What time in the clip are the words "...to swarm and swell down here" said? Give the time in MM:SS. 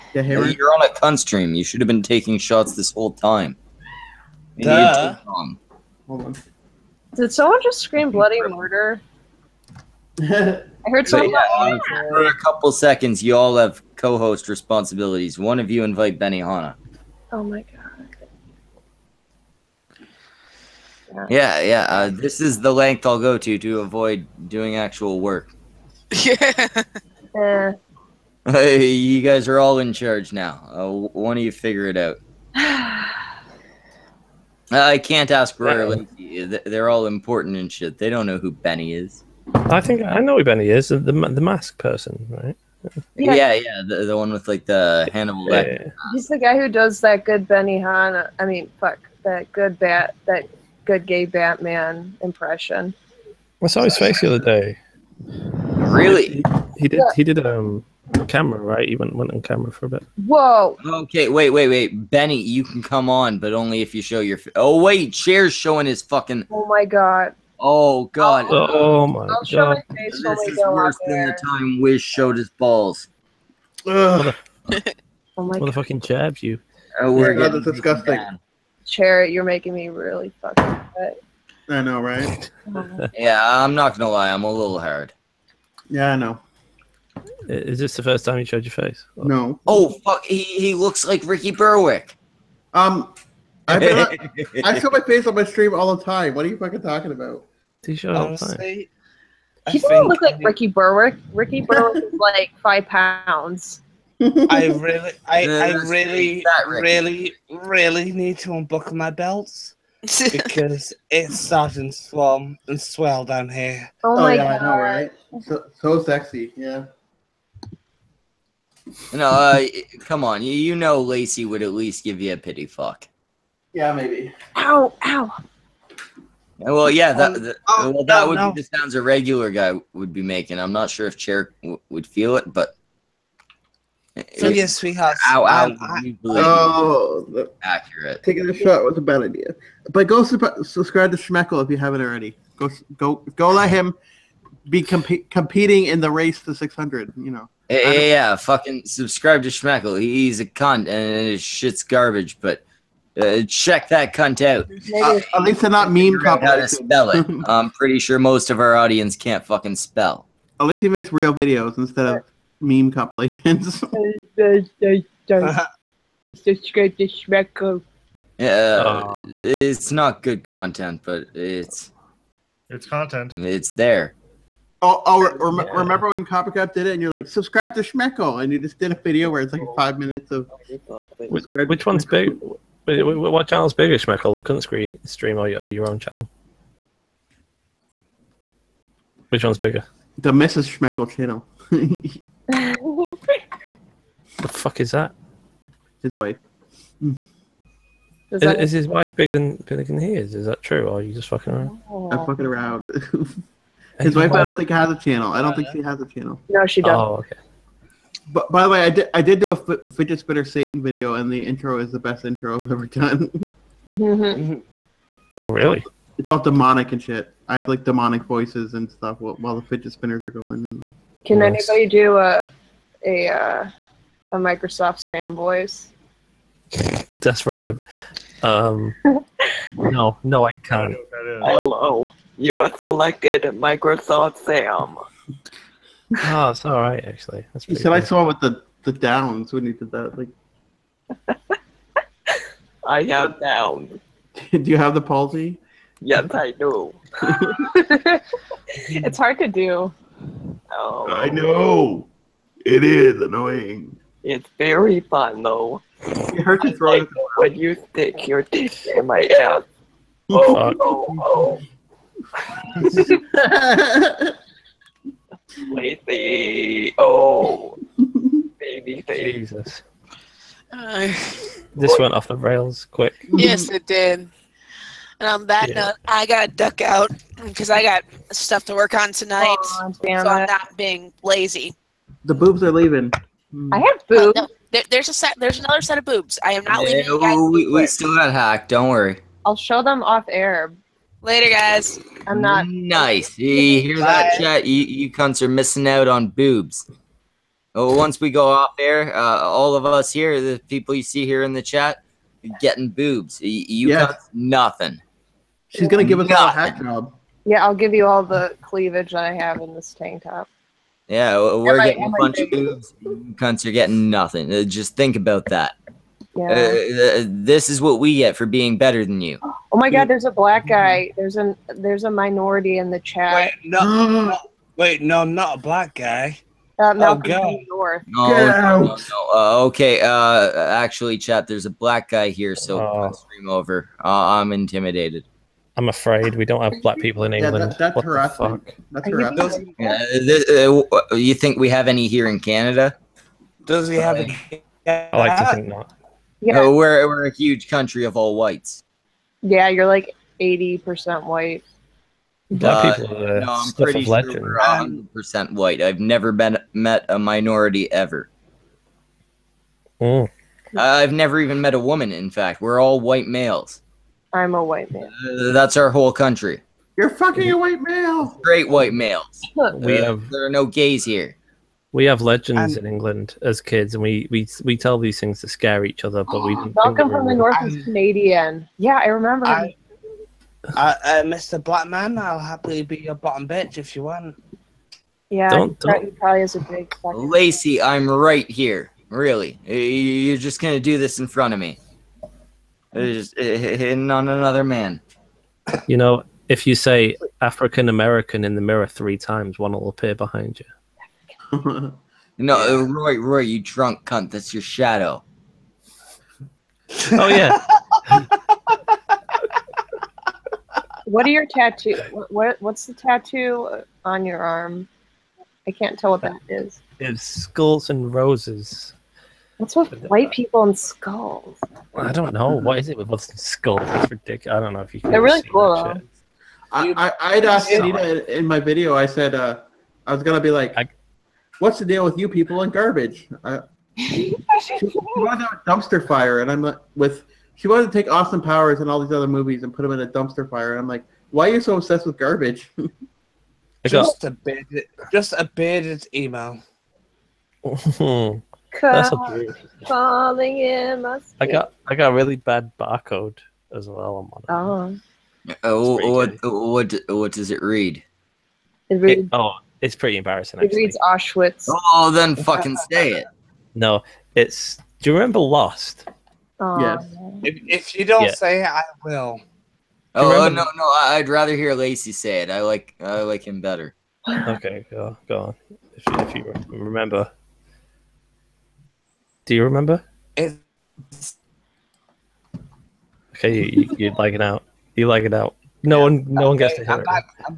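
01:51.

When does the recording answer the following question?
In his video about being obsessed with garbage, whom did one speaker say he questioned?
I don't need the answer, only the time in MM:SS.
07:07.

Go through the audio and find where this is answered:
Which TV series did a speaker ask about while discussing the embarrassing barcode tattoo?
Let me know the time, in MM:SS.
07:45.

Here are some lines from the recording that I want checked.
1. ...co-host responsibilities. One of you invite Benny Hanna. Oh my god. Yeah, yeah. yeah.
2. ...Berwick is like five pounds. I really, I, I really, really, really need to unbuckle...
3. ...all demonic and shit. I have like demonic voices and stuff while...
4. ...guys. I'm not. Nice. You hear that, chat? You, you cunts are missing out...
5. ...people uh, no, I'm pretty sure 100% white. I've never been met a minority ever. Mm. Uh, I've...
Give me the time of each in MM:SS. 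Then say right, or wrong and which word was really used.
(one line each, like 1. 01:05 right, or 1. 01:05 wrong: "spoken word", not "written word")
1. 00:13 right
2. 01:41 right
3. 03:36 right
4. 04:51 right
5. 05:52 right.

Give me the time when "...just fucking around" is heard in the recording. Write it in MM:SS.
03:21.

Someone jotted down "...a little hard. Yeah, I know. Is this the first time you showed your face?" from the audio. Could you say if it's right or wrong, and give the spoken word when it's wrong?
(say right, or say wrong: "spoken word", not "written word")
right.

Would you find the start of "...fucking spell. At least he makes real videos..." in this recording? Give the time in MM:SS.
02:39.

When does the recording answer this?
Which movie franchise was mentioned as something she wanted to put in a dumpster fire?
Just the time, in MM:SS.
07:18.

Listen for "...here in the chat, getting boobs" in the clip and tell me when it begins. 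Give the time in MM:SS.
05:01.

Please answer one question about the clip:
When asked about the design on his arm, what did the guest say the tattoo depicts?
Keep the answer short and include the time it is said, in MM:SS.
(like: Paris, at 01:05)
Skulls and roses, at 06:57.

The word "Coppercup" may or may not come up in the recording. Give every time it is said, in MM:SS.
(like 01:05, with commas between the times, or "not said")
02:56.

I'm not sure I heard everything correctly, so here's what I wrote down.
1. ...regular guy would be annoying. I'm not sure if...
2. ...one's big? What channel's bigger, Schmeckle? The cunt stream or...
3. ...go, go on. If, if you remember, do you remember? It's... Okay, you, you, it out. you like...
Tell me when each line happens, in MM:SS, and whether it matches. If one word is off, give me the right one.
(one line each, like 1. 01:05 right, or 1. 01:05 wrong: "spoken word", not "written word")
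1. 02:09 wrong: "making", not "annoying"
2. 03:01 right
3. 07:54 right.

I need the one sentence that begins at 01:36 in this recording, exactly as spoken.
What are you fucking talking about?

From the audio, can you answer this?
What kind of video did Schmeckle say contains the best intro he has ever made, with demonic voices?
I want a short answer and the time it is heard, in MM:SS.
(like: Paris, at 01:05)
Fidget spinner Satan video, at 03:29.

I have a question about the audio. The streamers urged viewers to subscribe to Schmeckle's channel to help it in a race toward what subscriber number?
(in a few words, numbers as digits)
600.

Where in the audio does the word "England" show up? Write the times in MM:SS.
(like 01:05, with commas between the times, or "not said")
05:37, 06:12.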